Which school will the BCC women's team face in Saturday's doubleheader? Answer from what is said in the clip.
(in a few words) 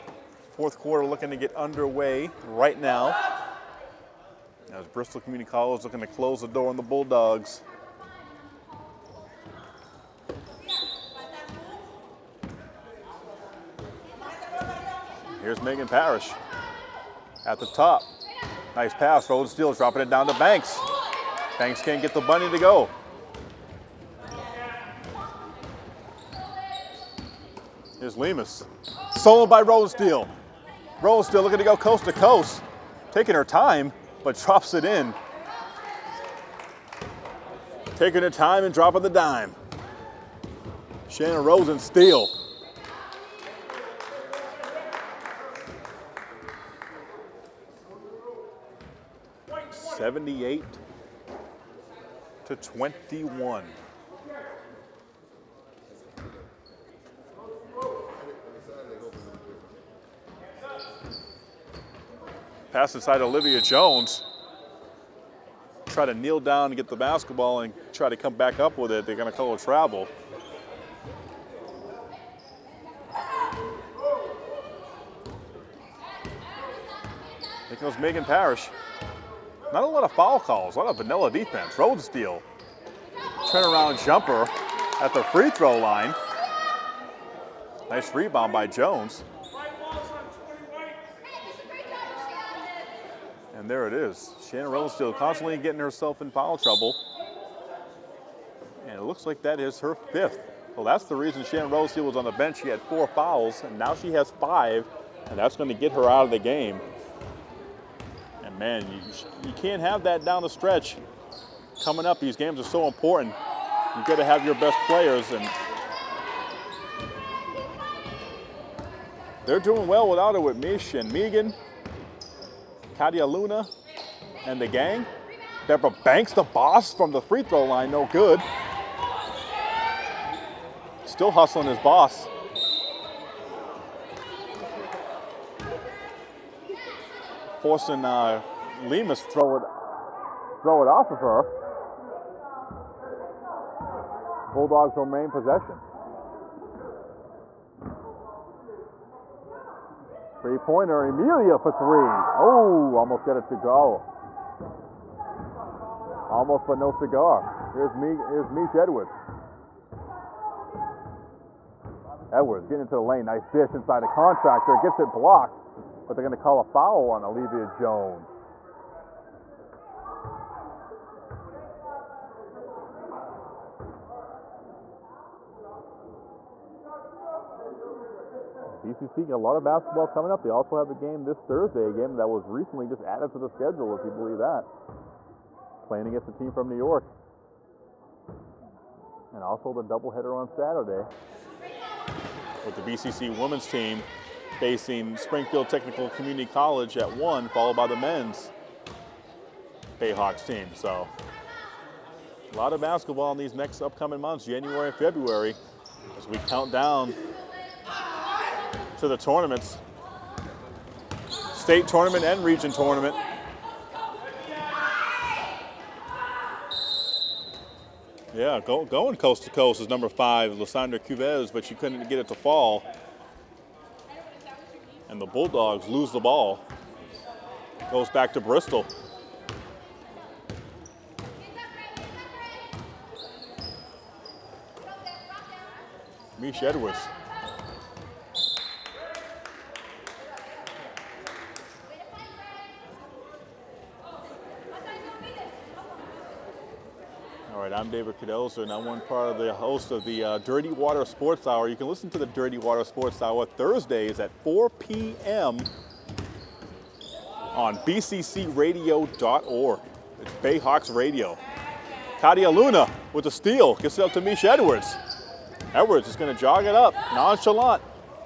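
Springfield Technical Community College.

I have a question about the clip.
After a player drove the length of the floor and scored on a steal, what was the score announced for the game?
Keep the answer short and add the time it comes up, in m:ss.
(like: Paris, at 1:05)
78 to 21, at 0:49.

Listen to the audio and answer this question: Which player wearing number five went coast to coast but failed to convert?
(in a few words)
Lissandra Cubas.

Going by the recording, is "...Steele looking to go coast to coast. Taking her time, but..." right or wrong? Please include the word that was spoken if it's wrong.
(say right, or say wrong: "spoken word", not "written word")
right.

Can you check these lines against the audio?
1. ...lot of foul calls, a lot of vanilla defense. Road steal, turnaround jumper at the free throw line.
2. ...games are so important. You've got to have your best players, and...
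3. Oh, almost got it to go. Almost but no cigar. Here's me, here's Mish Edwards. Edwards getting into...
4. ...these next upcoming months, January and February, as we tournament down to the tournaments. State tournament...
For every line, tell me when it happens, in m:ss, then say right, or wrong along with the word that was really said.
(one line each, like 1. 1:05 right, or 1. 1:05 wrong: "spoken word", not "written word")
1. 1:19 right
2. 1:52 right
3. 2:32 right
4. 3:23 wrong: "count", not "tournament".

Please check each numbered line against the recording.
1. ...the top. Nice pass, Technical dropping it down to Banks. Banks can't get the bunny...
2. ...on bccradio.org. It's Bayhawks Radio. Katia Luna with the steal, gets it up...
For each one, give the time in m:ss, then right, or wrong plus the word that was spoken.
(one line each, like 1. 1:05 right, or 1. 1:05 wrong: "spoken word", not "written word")
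1. 0:17 wrong: "Rosensteel", not "Technical"
2. 4:17 right.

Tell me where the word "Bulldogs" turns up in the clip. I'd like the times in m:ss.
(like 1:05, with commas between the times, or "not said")
0:06, 2:24, 3:45.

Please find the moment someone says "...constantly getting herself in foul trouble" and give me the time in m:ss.
1:35.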